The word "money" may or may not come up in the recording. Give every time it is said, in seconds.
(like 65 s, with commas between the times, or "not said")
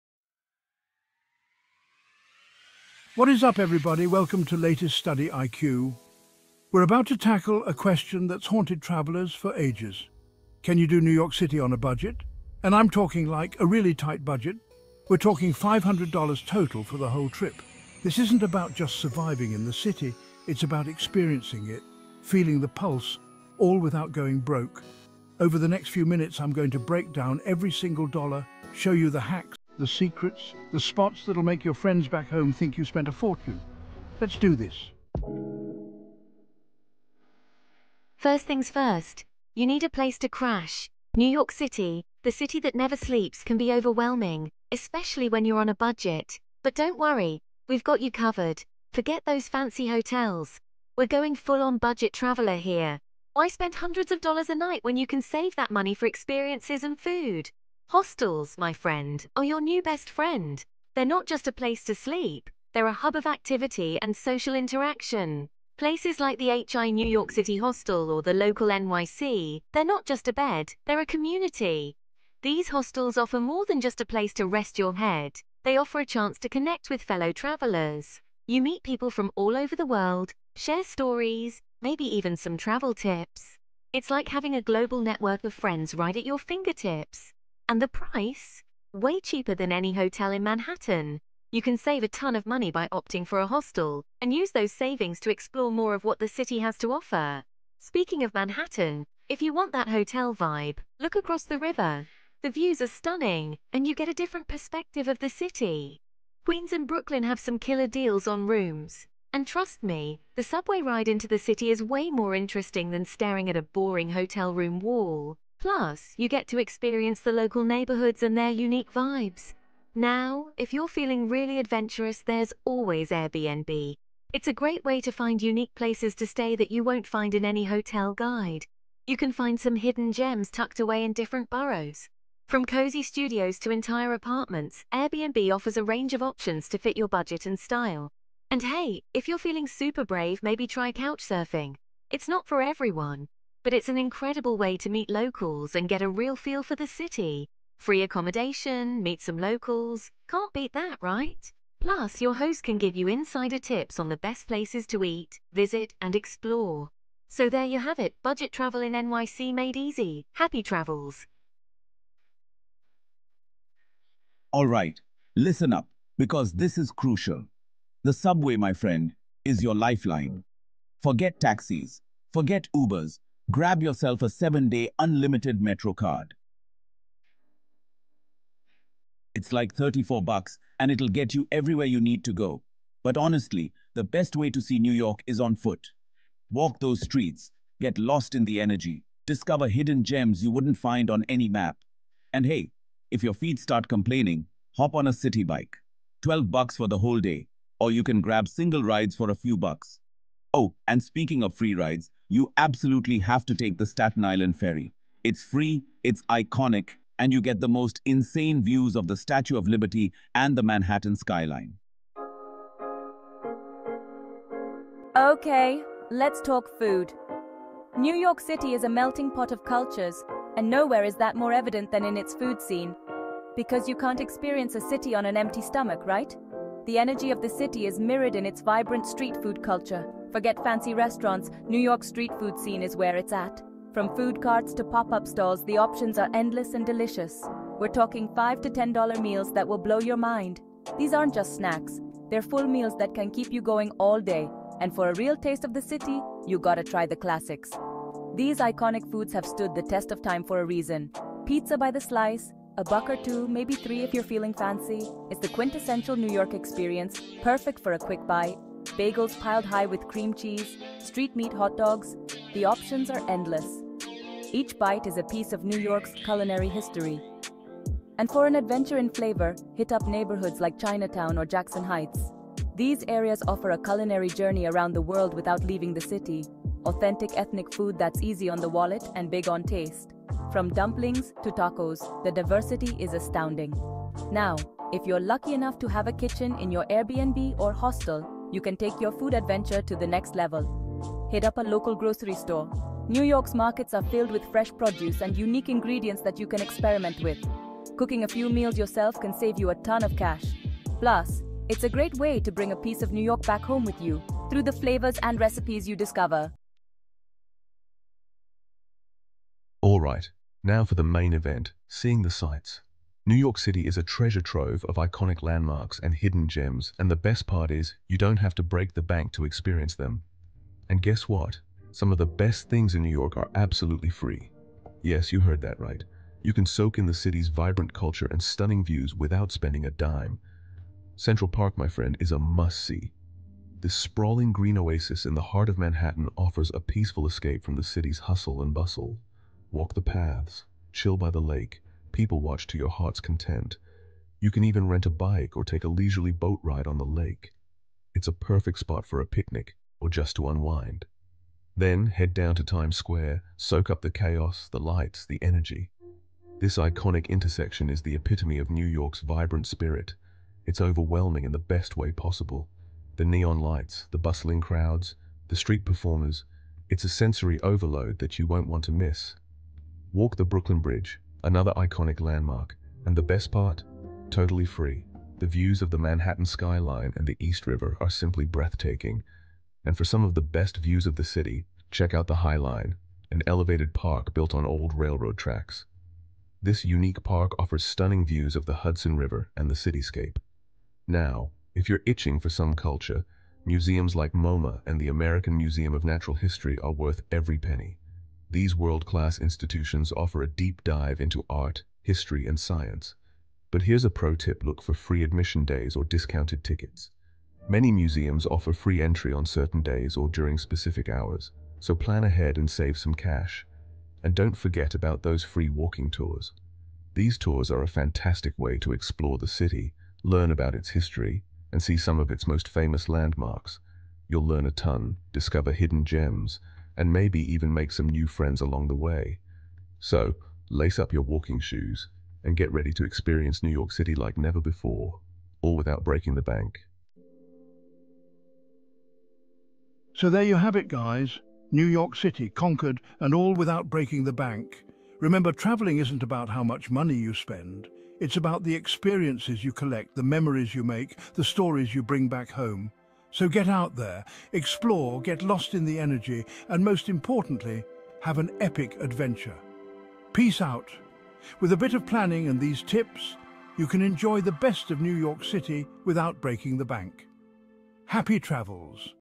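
55 s, 92 s, 446 s.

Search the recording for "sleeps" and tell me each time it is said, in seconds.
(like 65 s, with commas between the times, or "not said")
42 s, 61 s.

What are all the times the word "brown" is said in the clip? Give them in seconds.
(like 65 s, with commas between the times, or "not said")
not said.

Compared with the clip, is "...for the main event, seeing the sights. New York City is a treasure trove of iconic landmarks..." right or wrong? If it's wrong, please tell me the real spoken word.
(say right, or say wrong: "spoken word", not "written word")
right.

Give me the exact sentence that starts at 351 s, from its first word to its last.
Then head down to Times Square, soak up the chaos, the lights, the energy.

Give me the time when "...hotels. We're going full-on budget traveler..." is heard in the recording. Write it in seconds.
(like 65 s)
49 s.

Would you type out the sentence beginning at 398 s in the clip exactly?
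These world-class institutions offer a deep dive into art, history, and science.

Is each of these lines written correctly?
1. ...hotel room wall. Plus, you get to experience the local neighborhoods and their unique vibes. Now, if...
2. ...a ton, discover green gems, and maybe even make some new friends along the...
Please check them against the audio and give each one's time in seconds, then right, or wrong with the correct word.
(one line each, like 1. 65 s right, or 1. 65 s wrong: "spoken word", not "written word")
1. 114 s right
2. 424 s wrong: "hidden", not "green".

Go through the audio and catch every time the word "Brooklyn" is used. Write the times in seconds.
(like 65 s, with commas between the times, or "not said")
106 s, 370 s.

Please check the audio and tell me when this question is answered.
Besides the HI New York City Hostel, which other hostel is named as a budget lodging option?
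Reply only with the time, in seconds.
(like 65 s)
68 s.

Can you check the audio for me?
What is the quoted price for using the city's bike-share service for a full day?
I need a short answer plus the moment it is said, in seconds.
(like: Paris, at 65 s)
$12, at 196 s.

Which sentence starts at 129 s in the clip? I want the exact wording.
You can find some hidden gems tucked away in different boroughs.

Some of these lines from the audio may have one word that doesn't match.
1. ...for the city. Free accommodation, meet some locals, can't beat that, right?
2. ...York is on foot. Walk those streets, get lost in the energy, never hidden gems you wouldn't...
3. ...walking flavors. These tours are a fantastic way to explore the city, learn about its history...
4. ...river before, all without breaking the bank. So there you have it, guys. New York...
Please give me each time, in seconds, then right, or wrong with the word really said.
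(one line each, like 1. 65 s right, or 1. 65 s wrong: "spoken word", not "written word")
1. 146 s right
2. 184 s wrong: "discover", not "never"
3. 415 s wrong: "tours", not "flavors"
4. 434 s wrong: "never", not "river".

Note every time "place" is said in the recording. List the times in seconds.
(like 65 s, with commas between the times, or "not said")
39 s, 61 s, 65 s, 74 s, 125 s, 154 s.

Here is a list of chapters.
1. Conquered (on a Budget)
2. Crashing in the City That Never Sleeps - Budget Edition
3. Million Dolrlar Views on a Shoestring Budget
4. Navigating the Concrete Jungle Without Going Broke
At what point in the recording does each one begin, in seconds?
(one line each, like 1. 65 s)
1. 437 s
2. 35 s
3. 306 s
4. 161 s.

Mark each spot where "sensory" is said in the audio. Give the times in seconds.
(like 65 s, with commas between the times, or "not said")
367 s.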